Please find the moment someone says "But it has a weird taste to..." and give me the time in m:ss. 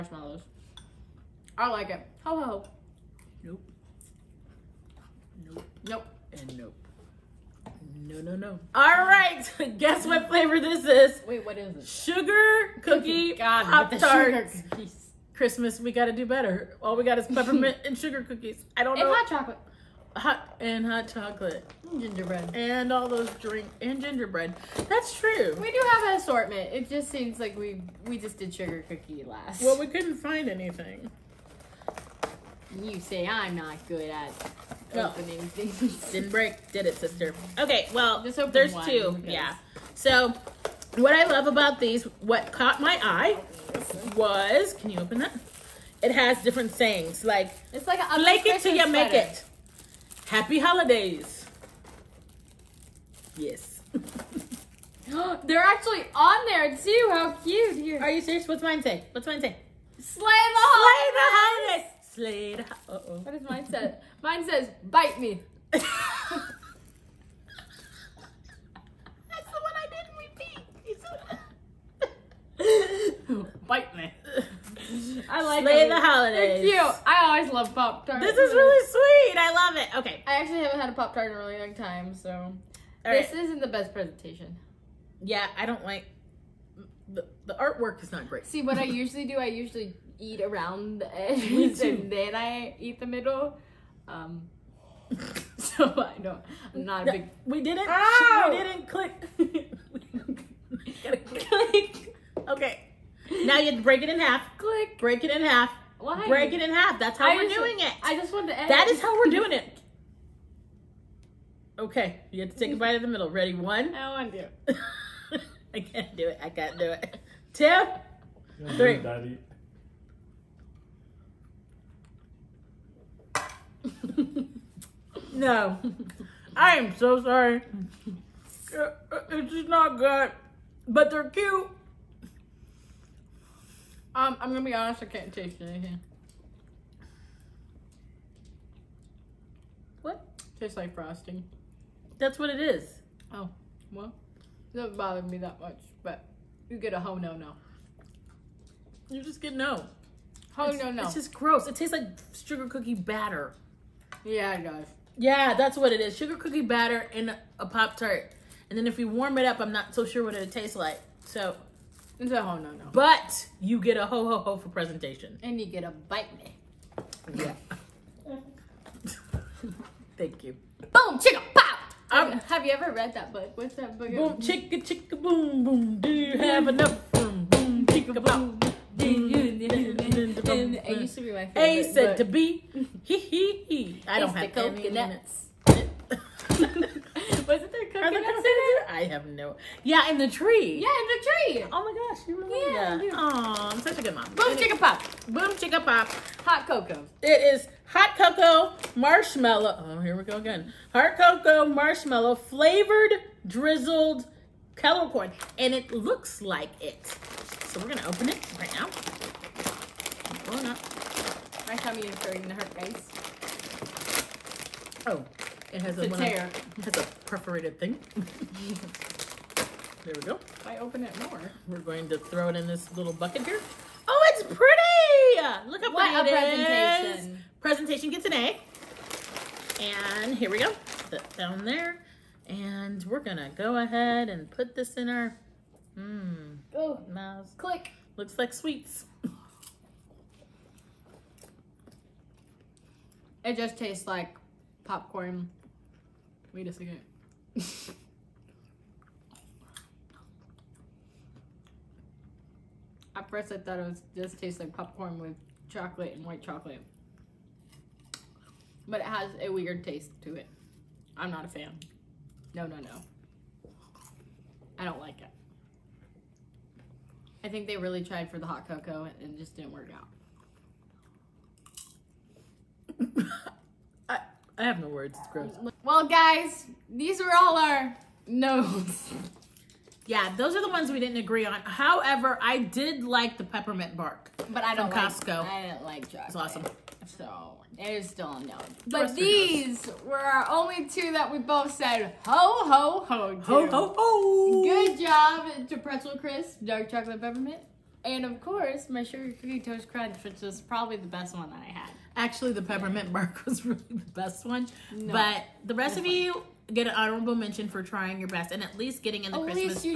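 4:18.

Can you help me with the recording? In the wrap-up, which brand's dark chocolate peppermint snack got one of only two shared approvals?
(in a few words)
Pretzel Crisp.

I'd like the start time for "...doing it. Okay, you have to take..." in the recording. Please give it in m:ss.
1:49.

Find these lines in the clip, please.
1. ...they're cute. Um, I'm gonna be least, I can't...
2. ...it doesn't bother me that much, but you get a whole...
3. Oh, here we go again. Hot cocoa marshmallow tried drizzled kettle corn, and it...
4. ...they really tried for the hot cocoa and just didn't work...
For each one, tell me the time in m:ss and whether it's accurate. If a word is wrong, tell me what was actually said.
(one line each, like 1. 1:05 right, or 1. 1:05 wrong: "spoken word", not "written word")
1. 2:11 wrong: "honest", not "least"
2. 2:24 right
3. 3:19 wrong: "flavored", not "tried"
4. 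4:27 right.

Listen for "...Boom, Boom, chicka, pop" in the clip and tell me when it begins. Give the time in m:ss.
2:57.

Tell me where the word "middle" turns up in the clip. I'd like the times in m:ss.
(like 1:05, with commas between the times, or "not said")
1:33, 1:53.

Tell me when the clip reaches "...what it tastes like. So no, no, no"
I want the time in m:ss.
2:40.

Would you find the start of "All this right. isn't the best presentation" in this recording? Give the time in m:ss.
1:22.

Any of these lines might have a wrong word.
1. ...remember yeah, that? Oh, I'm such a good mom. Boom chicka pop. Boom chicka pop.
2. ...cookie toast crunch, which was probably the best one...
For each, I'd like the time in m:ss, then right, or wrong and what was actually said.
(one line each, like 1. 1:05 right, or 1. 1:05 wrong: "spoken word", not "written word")
1. 3:12 right
2. 4:59 right.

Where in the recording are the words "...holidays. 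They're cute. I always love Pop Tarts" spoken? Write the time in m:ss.
1:16.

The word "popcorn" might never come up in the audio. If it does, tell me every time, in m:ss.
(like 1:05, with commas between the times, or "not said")
4:04, 4:14.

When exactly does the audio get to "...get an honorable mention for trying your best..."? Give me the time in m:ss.
5:06.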